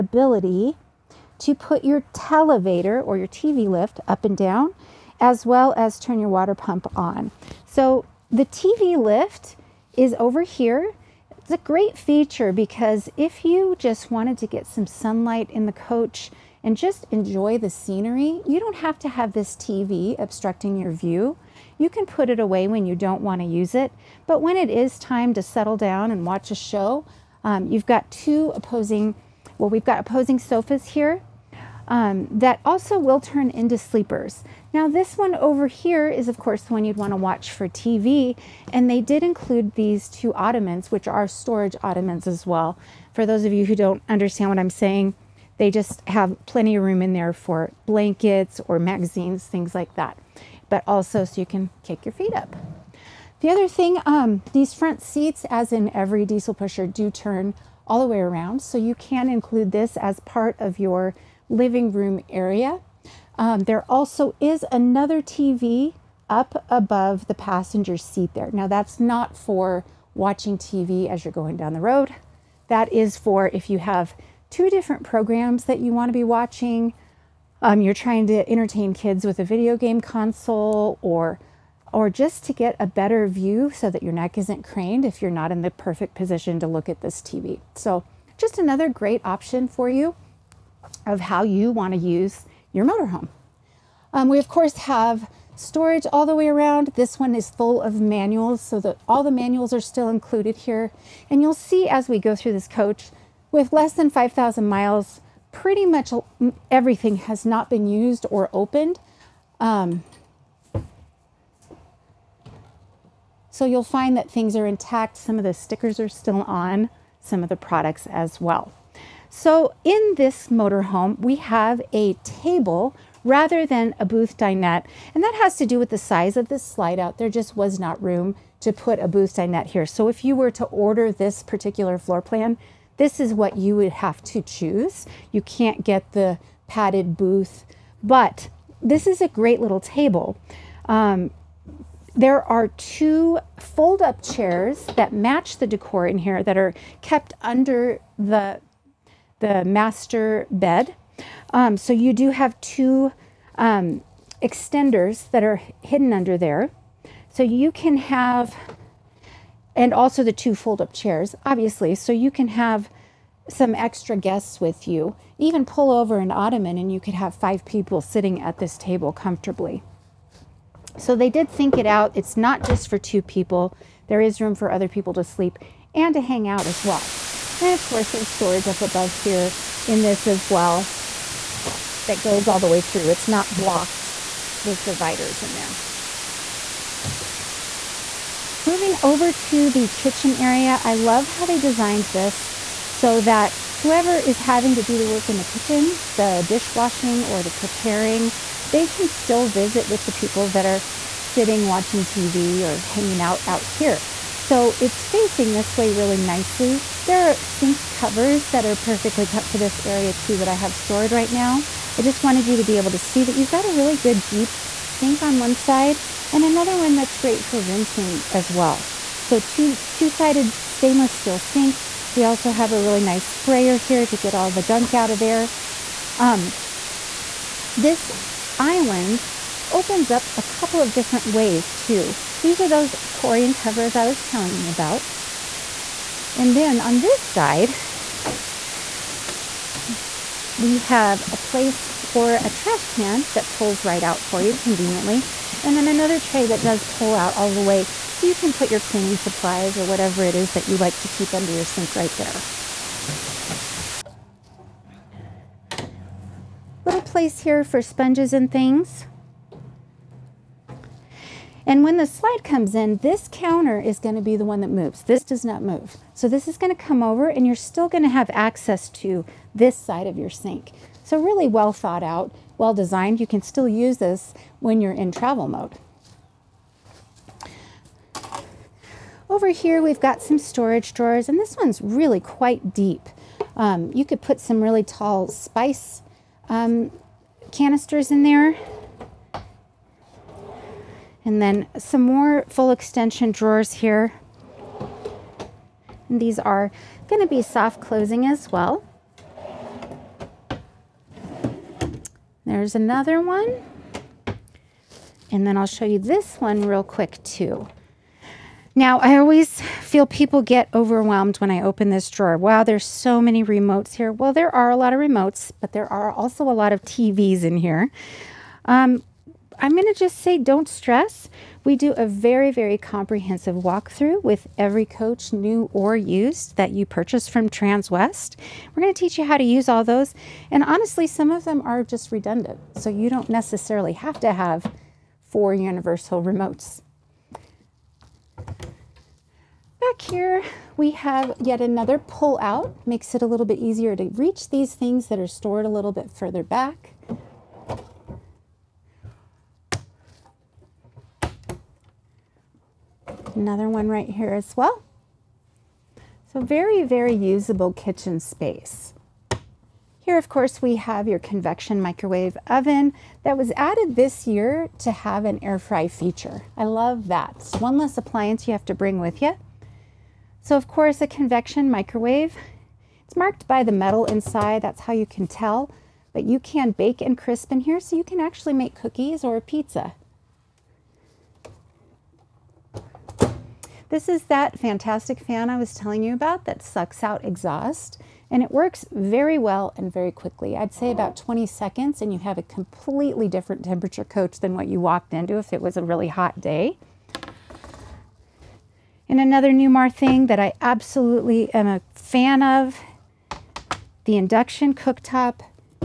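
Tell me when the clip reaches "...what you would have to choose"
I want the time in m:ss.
2:13.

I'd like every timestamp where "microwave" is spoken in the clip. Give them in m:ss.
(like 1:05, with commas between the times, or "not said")
6:01, 6:11.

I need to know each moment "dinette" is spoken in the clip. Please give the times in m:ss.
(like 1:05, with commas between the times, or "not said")
2:04, 2:09.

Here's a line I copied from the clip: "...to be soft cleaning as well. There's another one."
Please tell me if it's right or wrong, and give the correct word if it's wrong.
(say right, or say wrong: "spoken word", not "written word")
wrong: "closing", not "cleaning".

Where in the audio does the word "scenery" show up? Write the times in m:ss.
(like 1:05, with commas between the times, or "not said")
0:17.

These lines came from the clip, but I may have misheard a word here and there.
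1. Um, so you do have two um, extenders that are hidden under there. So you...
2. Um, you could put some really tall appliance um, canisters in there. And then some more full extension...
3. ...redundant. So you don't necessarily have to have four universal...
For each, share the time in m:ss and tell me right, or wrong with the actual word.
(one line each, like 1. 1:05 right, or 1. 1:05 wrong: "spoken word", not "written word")
1. 2:31 right
2. 4:43 wrong: "spice", not "appliance"
3. 5:32 right.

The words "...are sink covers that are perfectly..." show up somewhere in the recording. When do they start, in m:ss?
3:27.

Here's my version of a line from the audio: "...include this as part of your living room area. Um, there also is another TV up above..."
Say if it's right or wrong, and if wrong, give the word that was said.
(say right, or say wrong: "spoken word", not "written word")
right.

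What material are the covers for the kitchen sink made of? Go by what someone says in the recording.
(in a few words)
Corian.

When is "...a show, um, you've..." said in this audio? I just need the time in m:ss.
0:26.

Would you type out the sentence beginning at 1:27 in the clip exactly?
So just another great option for you of how you want to use your motorhome.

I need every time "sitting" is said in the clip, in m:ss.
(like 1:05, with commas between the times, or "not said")
2:48, 3:21.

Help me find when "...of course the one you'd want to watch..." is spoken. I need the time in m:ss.
0:36.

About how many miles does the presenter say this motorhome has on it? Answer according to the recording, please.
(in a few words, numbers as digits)
Less than 5,000.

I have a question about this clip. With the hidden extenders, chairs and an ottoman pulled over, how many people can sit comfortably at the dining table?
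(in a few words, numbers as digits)
5.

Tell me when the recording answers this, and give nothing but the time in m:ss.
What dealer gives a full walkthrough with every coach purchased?
5:27.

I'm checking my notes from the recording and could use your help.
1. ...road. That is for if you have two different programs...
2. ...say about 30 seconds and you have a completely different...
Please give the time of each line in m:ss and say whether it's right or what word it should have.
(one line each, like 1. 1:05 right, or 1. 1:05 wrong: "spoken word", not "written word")
1. 1:11 right
2. 6:30 wrong: "20", not "30".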